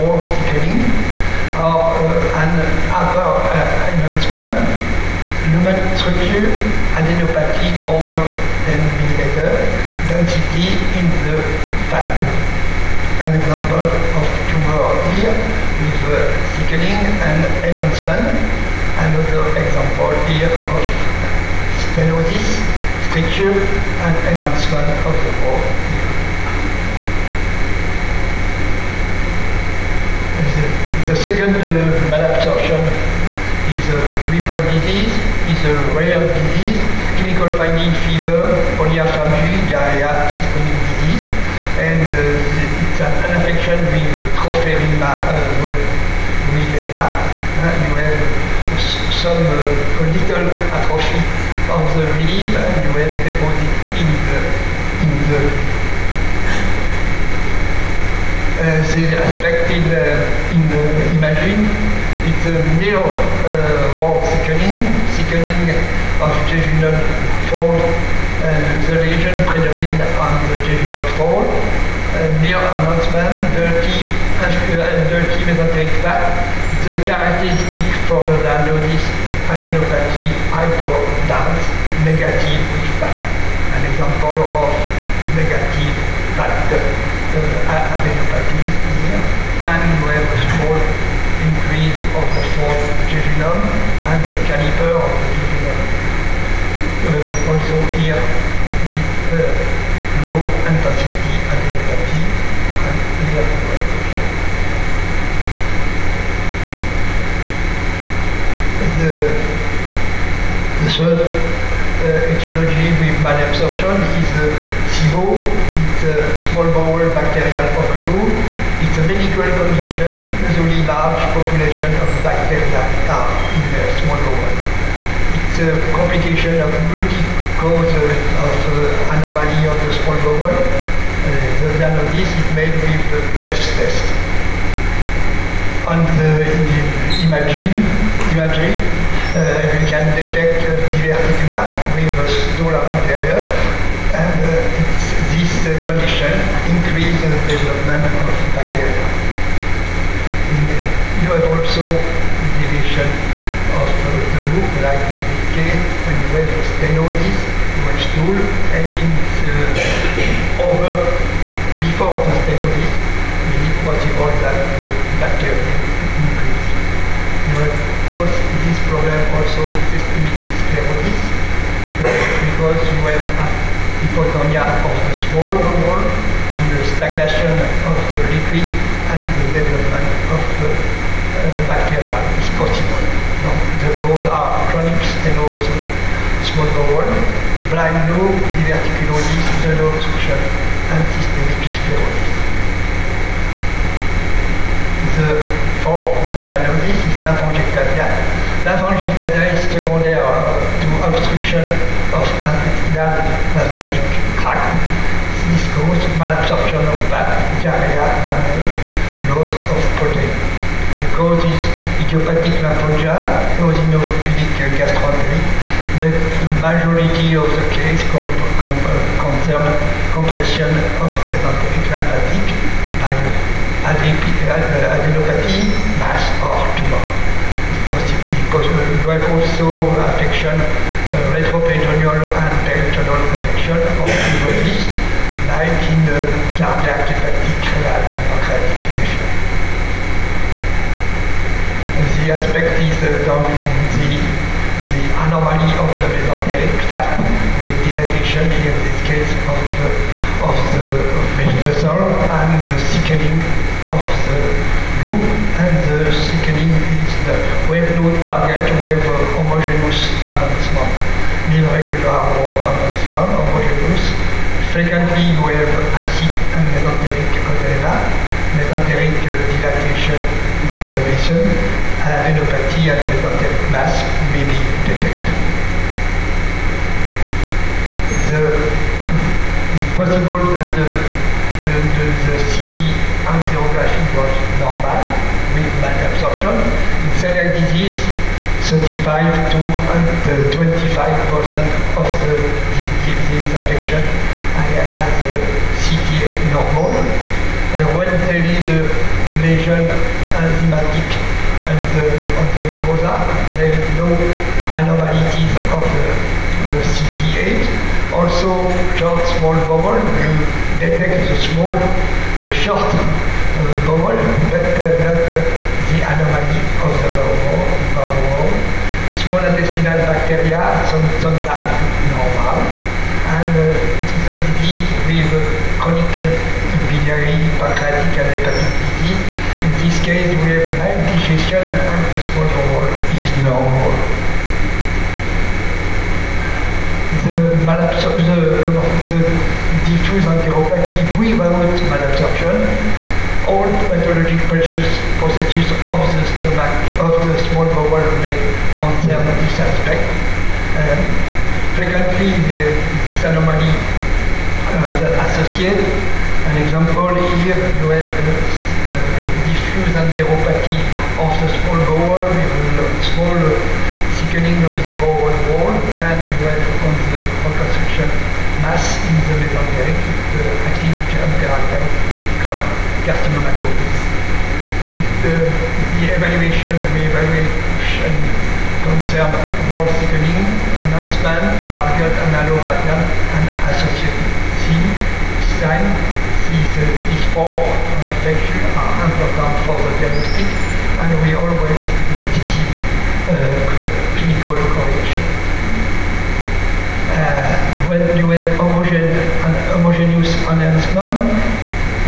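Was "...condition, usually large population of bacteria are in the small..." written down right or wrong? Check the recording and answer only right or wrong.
right.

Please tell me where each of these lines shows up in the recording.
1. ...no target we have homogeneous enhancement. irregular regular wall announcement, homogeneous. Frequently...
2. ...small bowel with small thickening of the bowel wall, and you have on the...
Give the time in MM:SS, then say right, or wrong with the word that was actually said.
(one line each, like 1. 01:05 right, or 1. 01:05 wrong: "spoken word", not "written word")
1. 04:17 right
2. 06:01 right.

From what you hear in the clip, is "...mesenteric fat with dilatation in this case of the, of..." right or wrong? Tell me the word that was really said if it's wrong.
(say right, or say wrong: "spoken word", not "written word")
right.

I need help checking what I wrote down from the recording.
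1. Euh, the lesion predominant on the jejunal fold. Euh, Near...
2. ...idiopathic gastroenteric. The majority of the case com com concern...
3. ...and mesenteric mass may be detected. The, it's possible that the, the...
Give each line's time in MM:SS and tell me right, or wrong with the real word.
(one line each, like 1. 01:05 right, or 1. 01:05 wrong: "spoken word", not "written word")
1. 01:07 right
2. 03:33 wrong: "eosinophilic", not "idiopathic"
3. 04:32 right.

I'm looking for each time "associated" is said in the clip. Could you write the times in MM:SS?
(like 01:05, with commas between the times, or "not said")
05:55, 06:23.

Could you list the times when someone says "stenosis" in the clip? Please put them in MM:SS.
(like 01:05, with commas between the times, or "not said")
00:21, 02:36, 02:42, 03:05.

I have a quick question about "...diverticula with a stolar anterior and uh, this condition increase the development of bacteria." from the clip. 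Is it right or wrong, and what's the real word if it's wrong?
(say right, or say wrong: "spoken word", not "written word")
right.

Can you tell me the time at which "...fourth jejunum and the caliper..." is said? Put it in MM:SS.
01:32.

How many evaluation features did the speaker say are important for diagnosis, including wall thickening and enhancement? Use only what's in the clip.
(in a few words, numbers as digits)
4.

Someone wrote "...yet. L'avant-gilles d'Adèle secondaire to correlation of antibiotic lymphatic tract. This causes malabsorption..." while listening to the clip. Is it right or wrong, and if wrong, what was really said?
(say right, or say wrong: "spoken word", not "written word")
wrong: "obstruction", not "correlation".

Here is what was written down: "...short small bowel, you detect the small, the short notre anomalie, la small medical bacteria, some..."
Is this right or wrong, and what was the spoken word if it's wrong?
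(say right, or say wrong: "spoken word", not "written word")
wrong: "intestinal", not "medical".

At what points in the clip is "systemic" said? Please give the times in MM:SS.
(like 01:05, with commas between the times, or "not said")
00:40, 02:49, 03:11.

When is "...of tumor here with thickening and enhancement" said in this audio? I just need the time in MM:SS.
00:13.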